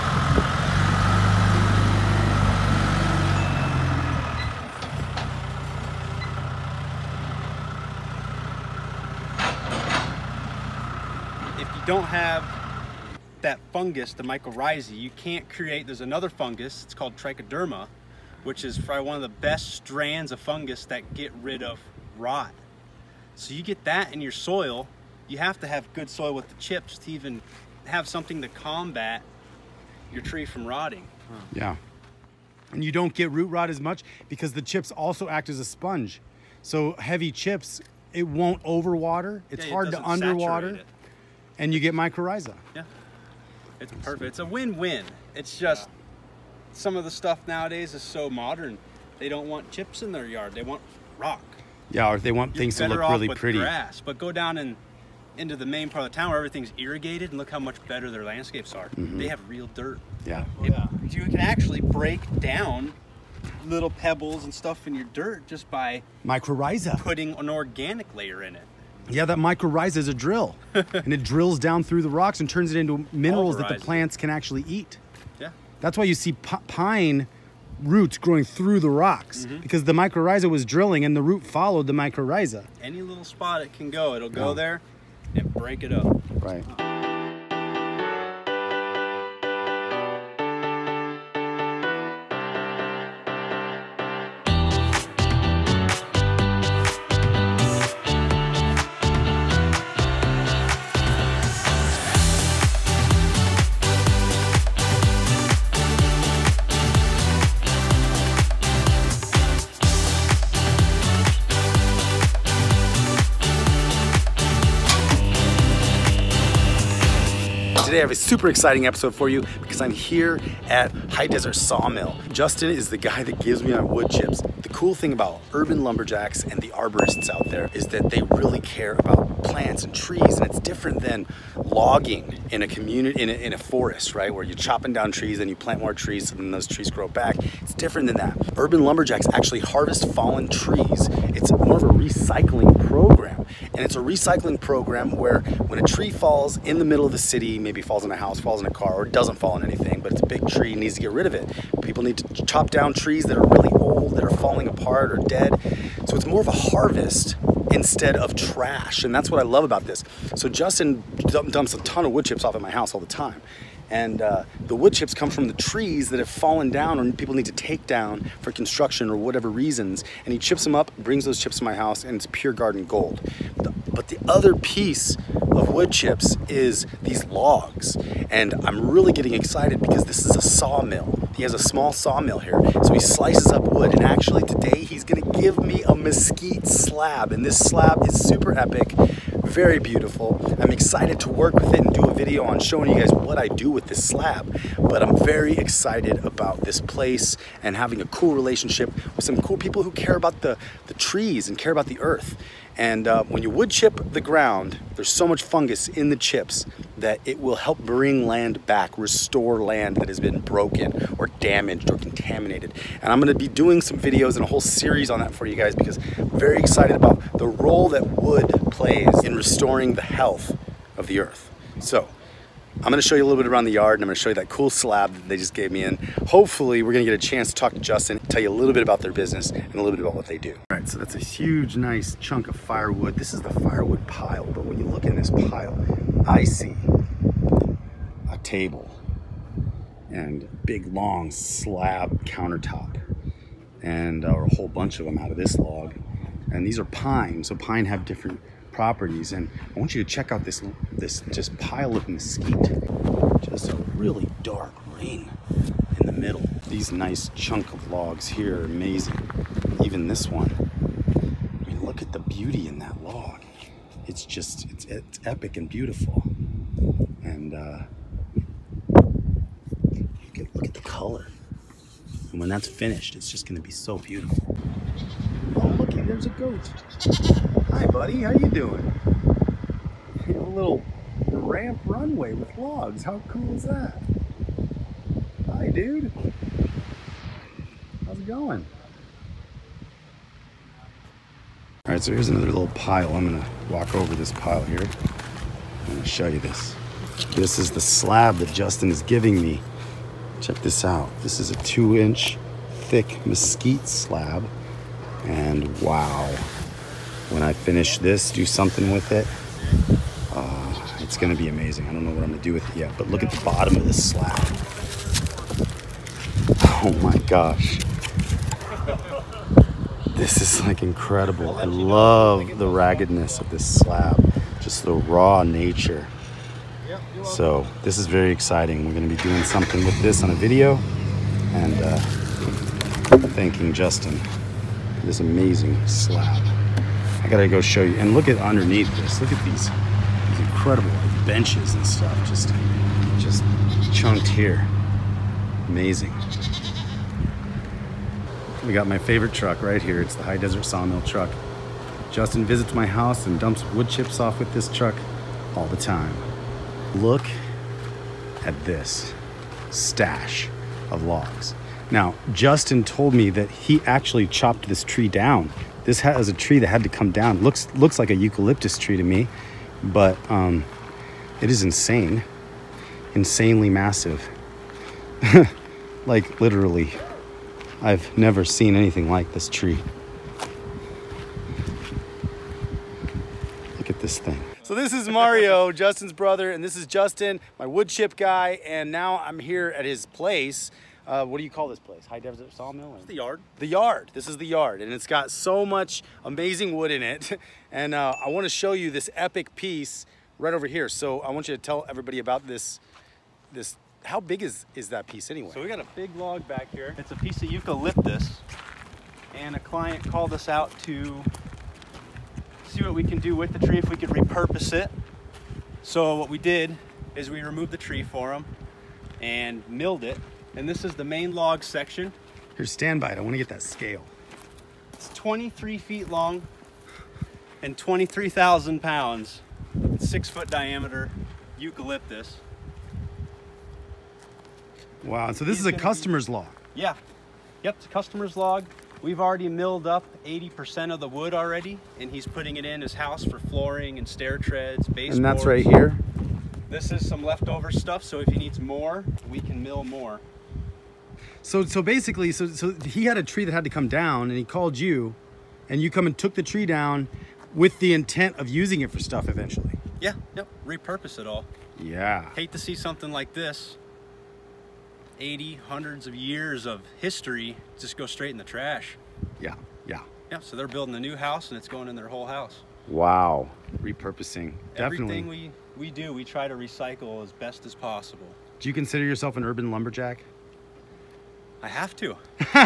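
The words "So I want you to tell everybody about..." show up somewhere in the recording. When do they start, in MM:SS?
06:40.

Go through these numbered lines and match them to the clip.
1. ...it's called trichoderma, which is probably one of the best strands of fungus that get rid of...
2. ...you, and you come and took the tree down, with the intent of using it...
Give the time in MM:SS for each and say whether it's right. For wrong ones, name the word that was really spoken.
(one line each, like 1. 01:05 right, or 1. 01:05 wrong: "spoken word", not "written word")
1. 00:16 right
2. 07:34 right.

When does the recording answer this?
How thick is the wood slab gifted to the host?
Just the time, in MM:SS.
05:01.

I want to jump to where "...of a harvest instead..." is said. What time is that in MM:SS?
02:36.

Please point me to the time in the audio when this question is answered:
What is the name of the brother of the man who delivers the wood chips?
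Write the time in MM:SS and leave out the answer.
06:25.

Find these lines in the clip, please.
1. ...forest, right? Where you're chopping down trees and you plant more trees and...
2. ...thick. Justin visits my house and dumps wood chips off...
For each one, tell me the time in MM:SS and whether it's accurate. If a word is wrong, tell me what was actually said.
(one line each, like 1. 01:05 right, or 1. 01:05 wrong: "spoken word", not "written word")
1. 02:13 right
2. 05:51 wrong: "truck", not "thick".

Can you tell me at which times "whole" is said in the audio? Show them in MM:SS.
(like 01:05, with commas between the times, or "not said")
03:34, 04:04, 07:52.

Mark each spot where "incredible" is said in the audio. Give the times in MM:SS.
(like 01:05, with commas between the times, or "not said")
05:20, 05:40.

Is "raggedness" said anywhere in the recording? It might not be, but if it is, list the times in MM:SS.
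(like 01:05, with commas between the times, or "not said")
05:22.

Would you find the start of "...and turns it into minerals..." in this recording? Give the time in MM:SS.
01:12.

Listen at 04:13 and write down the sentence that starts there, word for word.
Just a really dark lane in the middle.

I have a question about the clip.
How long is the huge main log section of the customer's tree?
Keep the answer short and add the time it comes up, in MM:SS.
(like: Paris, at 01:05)
23 feet, at 07:05.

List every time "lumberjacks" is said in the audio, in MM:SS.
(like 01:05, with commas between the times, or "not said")
02:05, 02:18, 07:59.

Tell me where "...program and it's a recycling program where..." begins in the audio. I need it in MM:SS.
02:22.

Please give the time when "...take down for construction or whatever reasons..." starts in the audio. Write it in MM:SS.
02:47.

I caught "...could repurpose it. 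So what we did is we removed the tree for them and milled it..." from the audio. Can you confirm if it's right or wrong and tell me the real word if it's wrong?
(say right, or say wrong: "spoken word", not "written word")
right.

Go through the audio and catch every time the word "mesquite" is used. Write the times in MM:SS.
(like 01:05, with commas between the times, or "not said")
03:05, 04:12, 05:03.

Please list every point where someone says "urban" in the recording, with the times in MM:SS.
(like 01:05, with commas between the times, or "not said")
02:05, 02:18, 07:59.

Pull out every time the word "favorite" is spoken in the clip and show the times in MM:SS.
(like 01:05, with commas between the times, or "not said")
05:48.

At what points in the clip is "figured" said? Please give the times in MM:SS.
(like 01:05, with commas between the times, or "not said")
not said.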